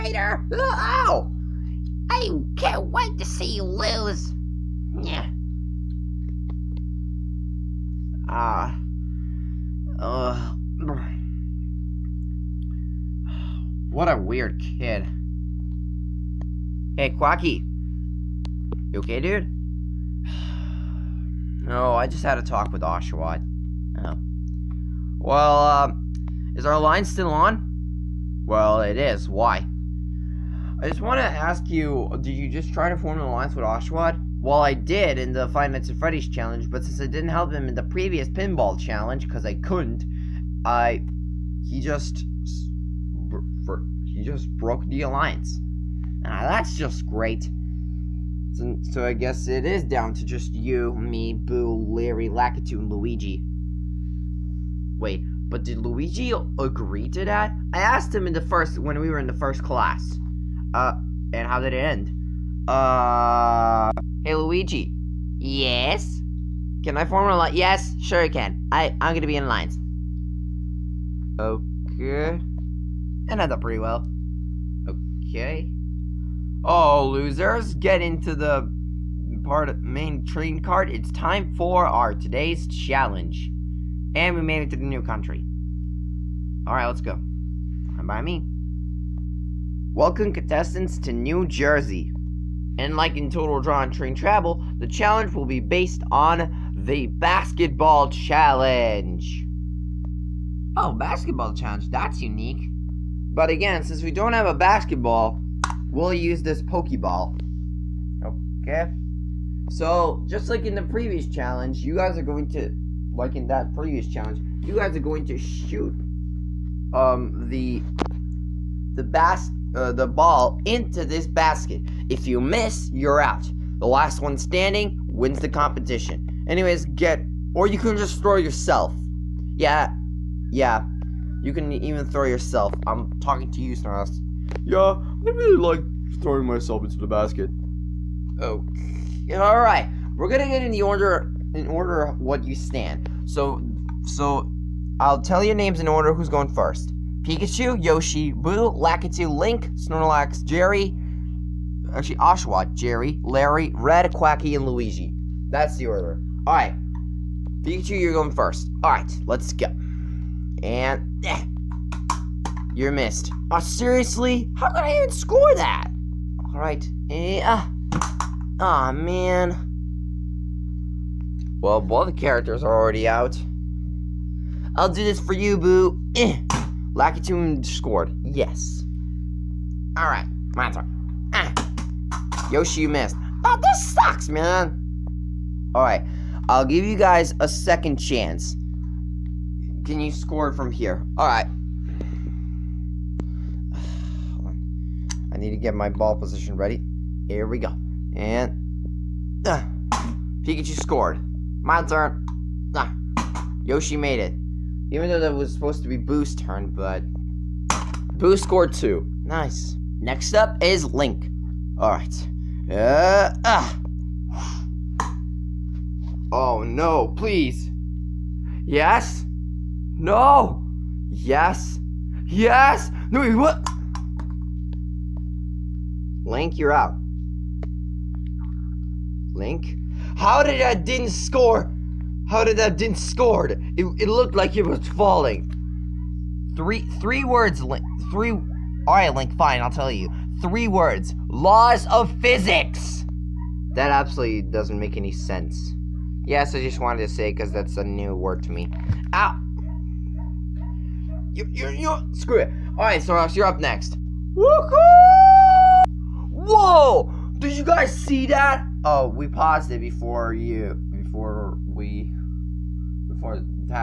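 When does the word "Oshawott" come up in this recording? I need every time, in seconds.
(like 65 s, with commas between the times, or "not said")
22 s, 33 s, 152 s.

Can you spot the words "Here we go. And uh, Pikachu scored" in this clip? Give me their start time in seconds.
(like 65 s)
197 s.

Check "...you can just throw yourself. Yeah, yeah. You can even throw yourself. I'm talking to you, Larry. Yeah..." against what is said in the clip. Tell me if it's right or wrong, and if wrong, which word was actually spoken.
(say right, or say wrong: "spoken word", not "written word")
wrong: "Snarls", not "Larry".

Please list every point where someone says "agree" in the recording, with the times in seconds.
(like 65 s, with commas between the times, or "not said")
56 s.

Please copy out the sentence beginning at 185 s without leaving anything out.
Alright, I'll give you guys a second chance.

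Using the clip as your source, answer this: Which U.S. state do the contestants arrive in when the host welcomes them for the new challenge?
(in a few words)
New Jersey.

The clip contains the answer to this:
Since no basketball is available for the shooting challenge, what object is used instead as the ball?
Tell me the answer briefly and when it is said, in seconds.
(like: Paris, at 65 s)
Pokeball, at 106 s.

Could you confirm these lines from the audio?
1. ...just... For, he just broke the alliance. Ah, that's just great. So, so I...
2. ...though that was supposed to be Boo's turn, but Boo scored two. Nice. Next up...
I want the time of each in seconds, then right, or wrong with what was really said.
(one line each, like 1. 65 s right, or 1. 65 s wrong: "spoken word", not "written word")
1. 41 s right
2. 205 s right.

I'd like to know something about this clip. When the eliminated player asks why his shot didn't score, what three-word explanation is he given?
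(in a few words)
Laws of physics.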